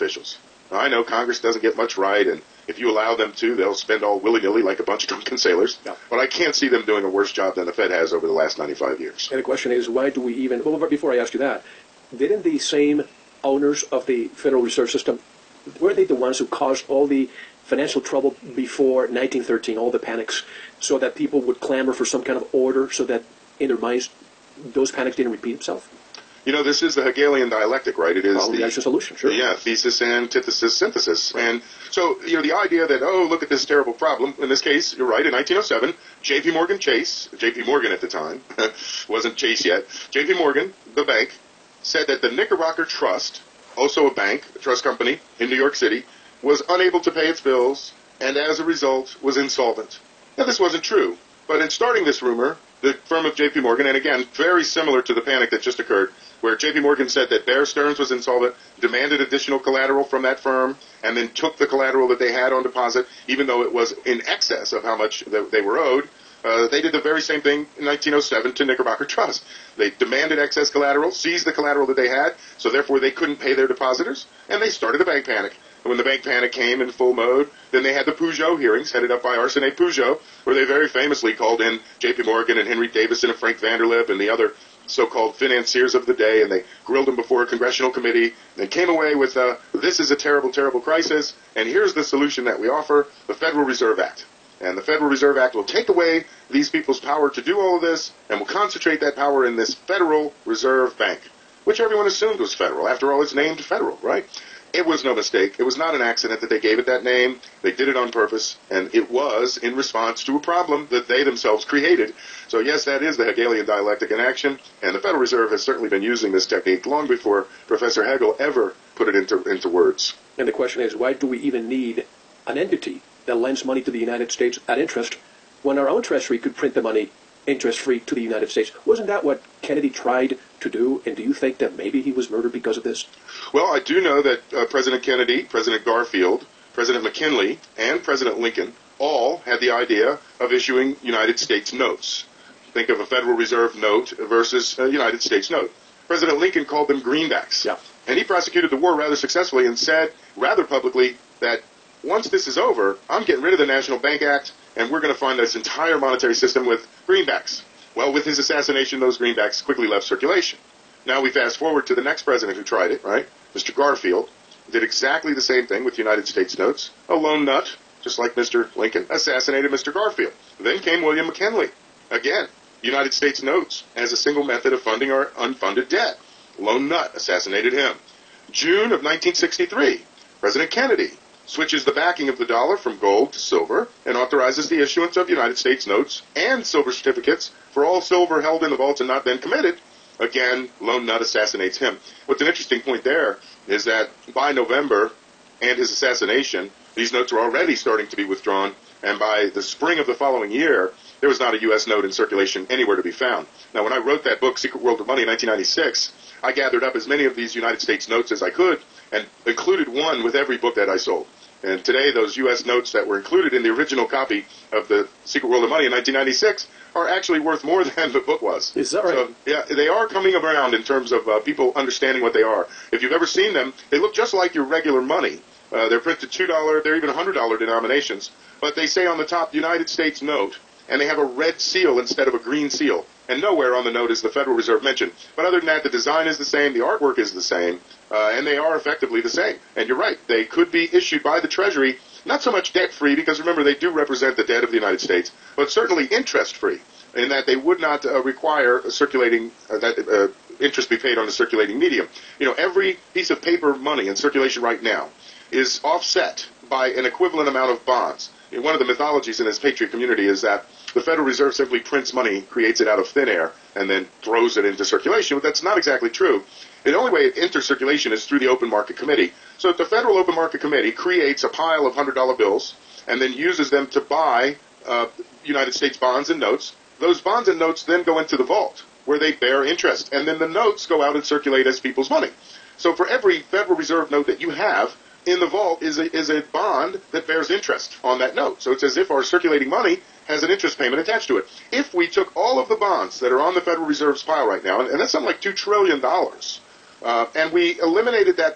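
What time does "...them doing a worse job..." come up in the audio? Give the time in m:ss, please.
0:06.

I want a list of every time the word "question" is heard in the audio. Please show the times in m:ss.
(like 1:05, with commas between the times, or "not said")
0:09, 2:00.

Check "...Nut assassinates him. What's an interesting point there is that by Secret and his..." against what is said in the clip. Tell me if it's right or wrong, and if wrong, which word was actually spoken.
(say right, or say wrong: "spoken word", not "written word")
wrong: "November", not "Secret".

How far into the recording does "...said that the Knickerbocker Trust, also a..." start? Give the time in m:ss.
0:41.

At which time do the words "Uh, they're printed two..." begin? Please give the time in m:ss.
3:45.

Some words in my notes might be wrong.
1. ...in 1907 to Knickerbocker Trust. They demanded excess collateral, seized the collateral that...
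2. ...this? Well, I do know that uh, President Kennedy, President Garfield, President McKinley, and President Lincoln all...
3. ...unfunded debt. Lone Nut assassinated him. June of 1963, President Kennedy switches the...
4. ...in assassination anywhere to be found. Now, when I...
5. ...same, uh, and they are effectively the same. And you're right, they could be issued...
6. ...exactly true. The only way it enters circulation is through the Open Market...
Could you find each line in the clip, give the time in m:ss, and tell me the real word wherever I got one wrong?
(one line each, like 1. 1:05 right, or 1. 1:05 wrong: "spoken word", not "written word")
1. 1:07 right
2. 2:12 right
3. 2:55 right
4. 3:22 wrong: "circulation", not "assassination"
5. 3:57 right
6. 4:25 right.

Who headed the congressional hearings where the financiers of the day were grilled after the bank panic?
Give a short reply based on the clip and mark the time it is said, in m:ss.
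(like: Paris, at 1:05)
Arsene Pujo, at 1:19.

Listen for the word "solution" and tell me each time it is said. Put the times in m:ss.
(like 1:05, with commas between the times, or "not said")
0:28, 1:32.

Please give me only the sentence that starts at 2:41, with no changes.
Now we fast forward to the next president who tried it, right?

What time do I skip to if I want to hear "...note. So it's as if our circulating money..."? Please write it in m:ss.
4:48.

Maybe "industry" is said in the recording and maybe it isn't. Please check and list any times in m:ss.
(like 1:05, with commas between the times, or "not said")
not said.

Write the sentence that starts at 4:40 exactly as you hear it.
And then the notes go out and circulate as people's money.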